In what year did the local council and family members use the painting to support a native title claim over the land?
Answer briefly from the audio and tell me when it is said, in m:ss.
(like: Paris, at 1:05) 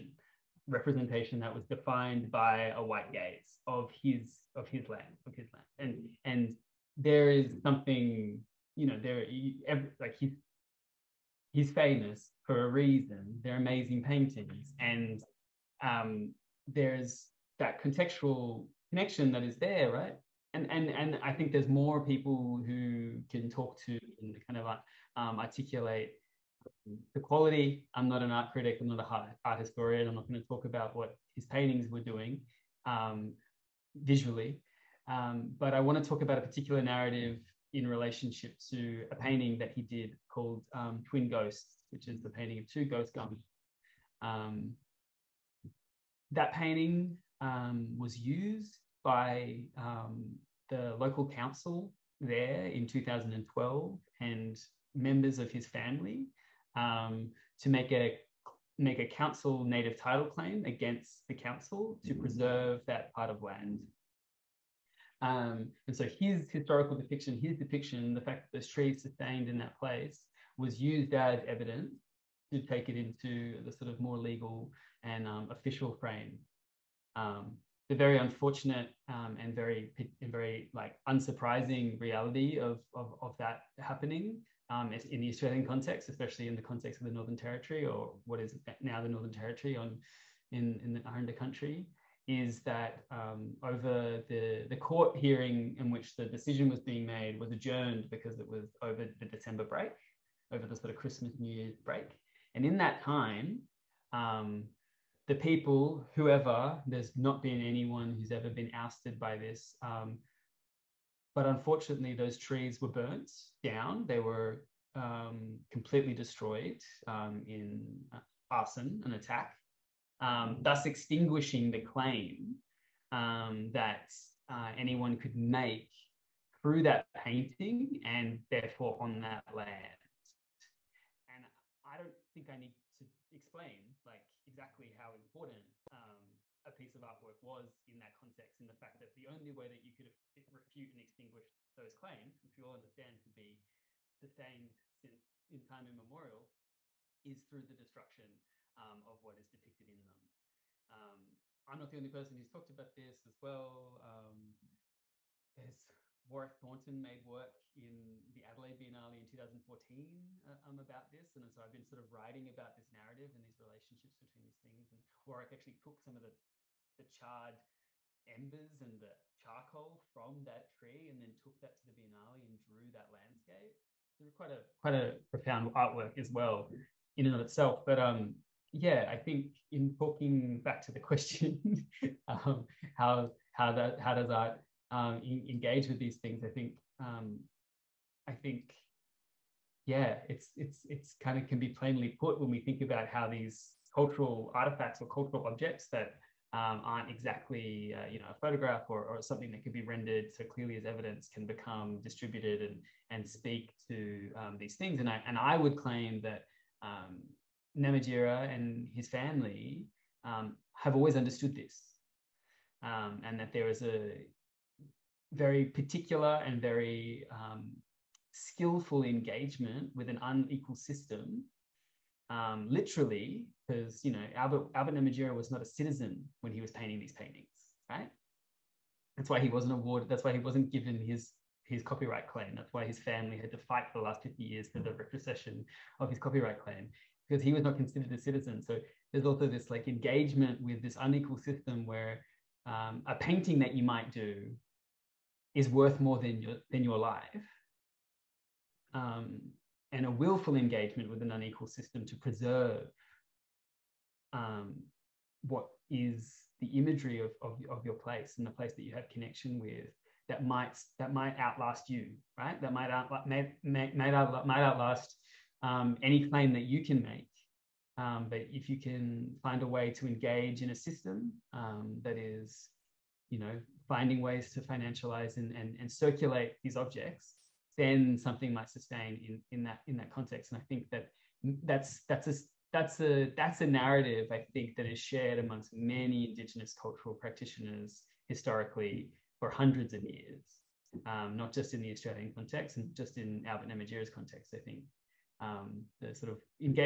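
2012, at 0:52.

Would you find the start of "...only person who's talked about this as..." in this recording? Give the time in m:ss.
2:31.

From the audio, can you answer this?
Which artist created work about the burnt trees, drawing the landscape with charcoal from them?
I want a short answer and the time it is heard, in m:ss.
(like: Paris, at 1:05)
Warwick Thornton, at 2:36.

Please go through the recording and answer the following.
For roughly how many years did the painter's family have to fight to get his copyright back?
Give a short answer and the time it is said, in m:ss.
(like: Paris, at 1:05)
50, at 3:54.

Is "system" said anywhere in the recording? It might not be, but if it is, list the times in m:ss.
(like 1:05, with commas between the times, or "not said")
3:40, 4:01, 4:11, 4:30.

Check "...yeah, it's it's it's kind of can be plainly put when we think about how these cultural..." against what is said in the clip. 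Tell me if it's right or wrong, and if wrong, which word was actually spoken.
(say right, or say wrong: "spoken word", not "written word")
right.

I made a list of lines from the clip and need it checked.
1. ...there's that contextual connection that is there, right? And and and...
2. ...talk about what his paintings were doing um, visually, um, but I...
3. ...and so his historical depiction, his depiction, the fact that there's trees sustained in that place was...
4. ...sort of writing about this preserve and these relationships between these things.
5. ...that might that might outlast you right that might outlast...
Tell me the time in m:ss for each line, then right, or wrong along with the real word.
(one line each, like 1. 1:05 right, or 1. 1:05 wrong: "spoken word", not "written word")
1. 0:16 right
2. 0:30 right
3. 1:05 right
4. 2:41 wrong: "narrative", not "preserve"
5. 4:20 right.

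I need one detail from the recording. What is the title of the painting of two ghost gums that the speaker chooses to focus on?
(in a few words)
Twin Ghosts.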